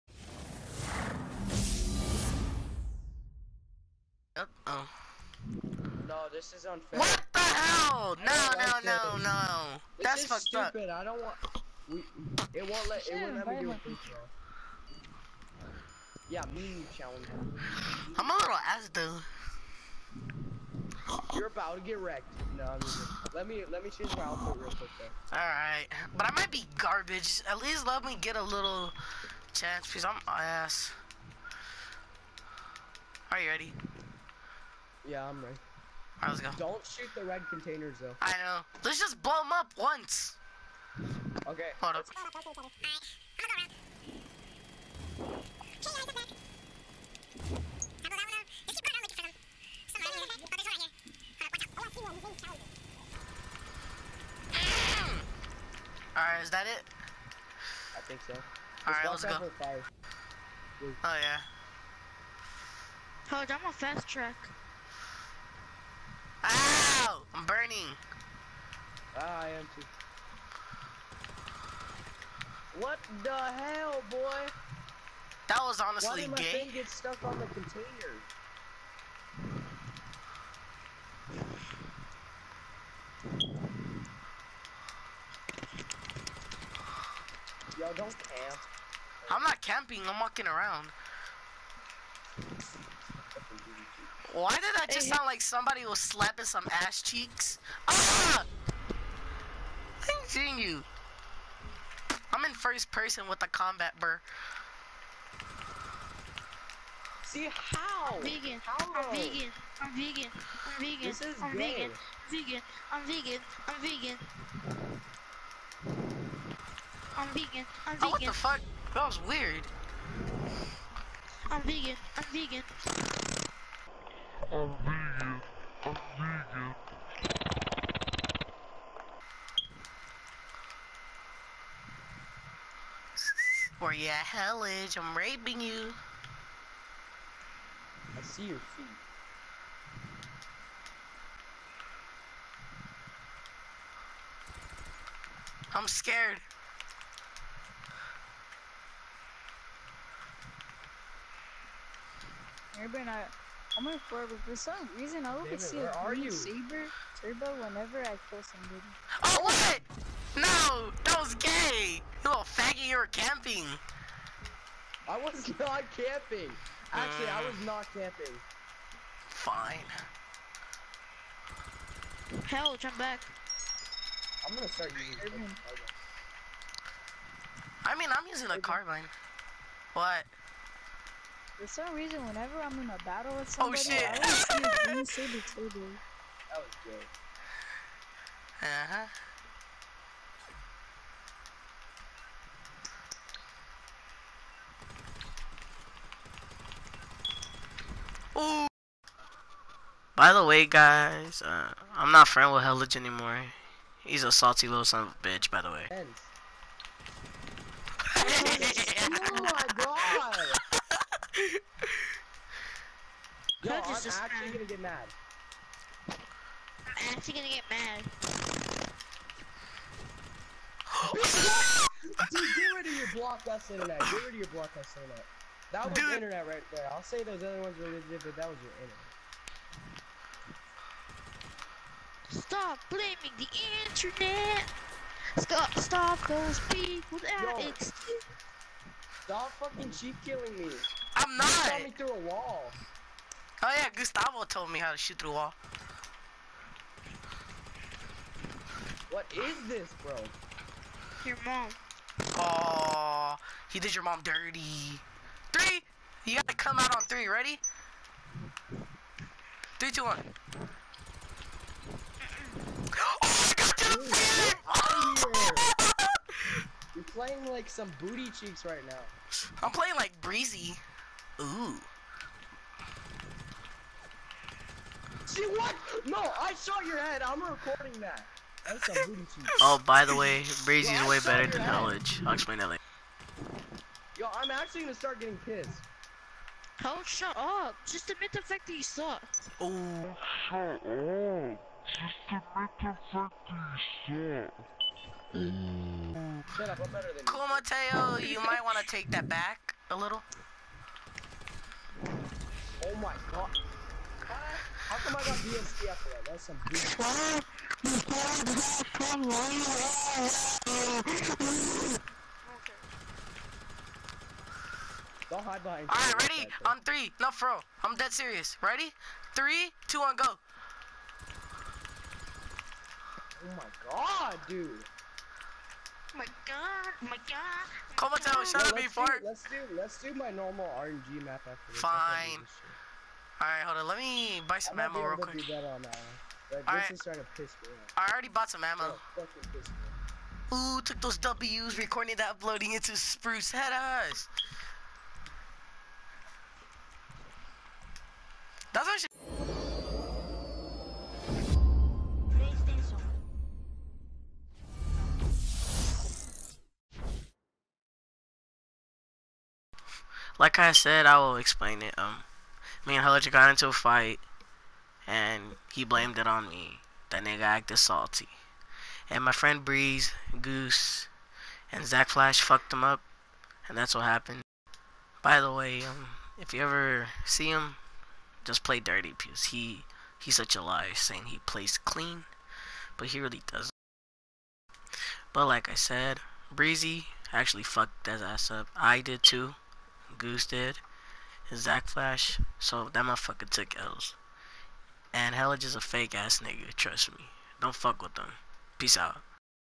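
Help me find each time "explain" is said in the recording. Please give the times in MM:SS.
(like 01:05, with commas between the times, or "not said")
04:42, 06:01.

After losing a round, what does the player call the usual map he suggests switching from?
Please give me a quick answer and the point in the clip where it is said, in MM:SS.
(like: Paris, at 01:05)
RNG map, at 05:30.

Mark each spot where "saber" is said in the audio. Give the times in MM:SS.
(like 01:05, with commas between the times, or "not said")
02:36, 03:05.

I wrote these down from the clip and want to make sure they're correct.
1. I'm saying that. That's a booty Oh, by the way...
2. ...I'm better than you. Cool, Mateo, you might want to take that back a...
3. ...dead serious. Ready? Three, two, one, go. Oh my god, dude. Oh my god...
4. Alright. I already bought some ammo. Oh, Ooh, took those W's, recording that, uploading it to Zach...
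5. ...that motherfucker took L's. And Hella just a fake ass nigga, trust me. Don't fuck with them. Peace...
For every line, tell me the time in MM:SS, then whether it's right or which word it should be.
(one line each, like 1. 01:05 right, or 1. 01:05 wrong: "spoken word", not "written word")
1. 04:37 wrong: "recording", not "saying"
2. 04:56 right
3. 05:17 right
4. 05:35 wrong: "Spruce", not "Zach"
5. 06:32 right.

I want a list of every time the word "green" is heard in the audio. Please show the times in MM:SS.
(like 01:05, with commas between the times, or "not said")
02:36, 03:04.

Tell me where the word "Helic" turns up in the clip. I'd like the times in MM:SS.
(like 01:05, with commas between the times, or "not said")
06:03.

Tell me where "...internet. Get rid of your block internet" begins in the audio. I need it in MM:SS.
03:43.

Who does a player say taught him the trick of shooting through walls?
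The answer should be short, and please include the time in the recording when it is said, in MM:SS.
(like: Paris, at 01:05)
Gustavo, at 04:03.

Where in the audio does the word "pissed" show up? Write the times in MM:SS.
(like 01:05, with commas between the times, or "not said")
04:45.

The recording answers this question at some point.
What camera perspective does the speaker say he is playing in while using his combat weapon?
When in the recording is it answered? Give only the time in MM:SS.
01:42.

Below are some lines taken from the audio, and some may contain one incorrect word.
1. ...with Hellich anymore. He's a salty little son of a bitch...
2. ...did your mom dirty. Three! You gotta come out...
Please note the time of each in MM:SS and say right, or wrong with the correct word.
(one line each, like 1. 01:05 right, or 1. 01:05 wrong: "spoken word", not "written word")
1. 03:22 right
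2. 04:13 right.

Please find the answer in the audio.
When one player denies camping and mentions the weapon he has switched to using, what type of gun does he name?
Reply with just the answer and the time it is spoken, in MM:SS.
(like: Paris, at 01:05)
Carbine, at 02:58.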